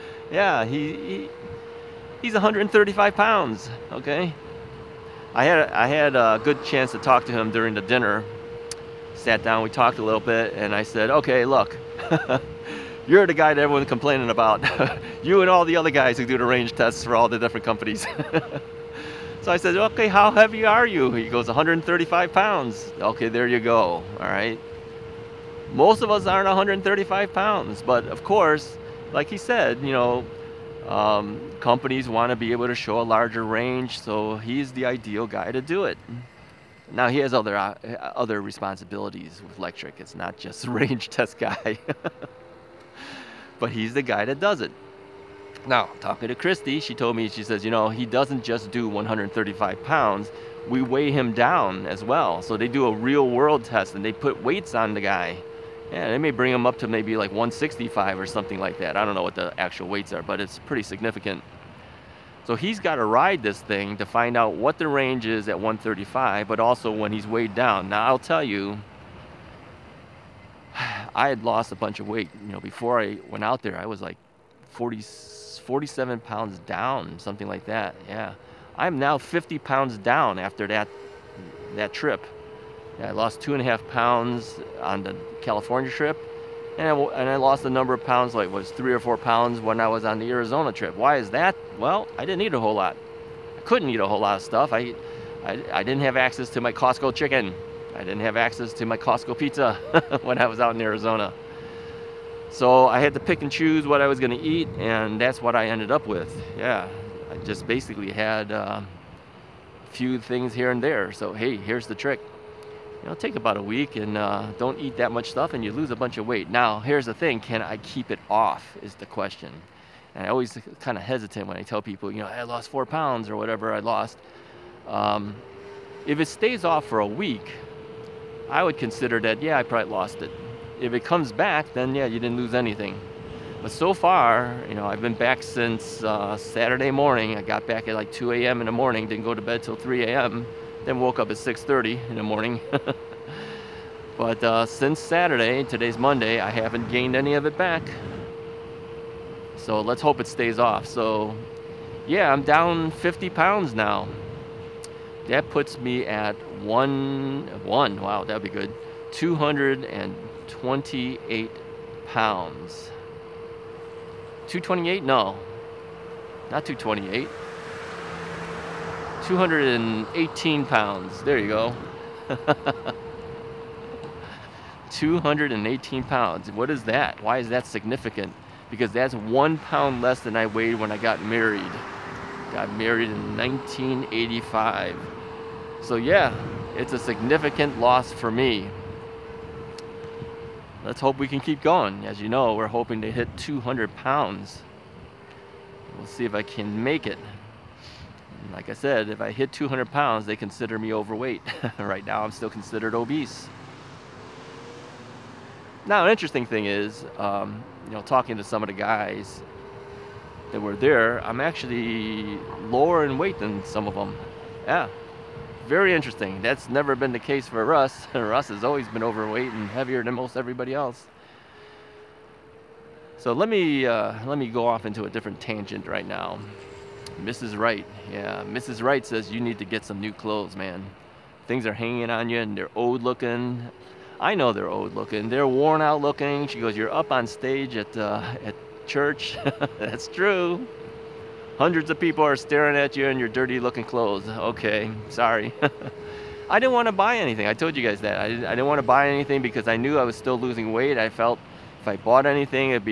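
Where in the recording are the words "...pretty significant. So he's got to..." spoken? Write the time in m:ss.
1:00.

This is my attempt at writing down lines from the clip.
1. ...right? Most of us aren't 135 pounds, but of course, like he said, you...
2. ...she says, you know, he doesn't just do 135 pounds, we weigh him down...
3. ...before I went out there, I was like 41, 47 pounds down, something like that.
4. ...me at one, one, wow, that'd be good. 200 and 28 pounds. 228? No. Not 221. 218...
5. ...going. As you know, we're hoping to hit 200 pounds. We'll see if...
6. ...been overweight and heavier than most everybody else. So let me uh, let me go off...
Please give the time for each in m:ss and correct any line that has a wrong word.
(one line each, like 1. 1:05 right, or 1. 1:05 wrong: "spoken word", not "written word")
1. 0:24 right
2. 0:47 right
3. 1:12 wrong: "40", not "41"
4. 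2:35 wrong: "228", not "221"
5. 3:11 right
6. 3:38 right.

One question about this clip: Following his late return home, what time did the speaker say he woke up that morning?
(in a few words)
6:30.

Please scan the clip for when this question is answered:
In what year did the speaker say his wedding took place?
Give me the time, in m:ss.
3:03.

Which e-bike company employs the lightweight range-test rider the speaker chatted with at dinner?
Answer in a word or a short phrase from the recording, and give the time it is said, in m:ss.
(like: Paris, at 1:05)
Lectric, at 0:39.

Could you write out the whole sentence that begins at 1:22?
Yeah, I lost two and a half pounds on the California trip.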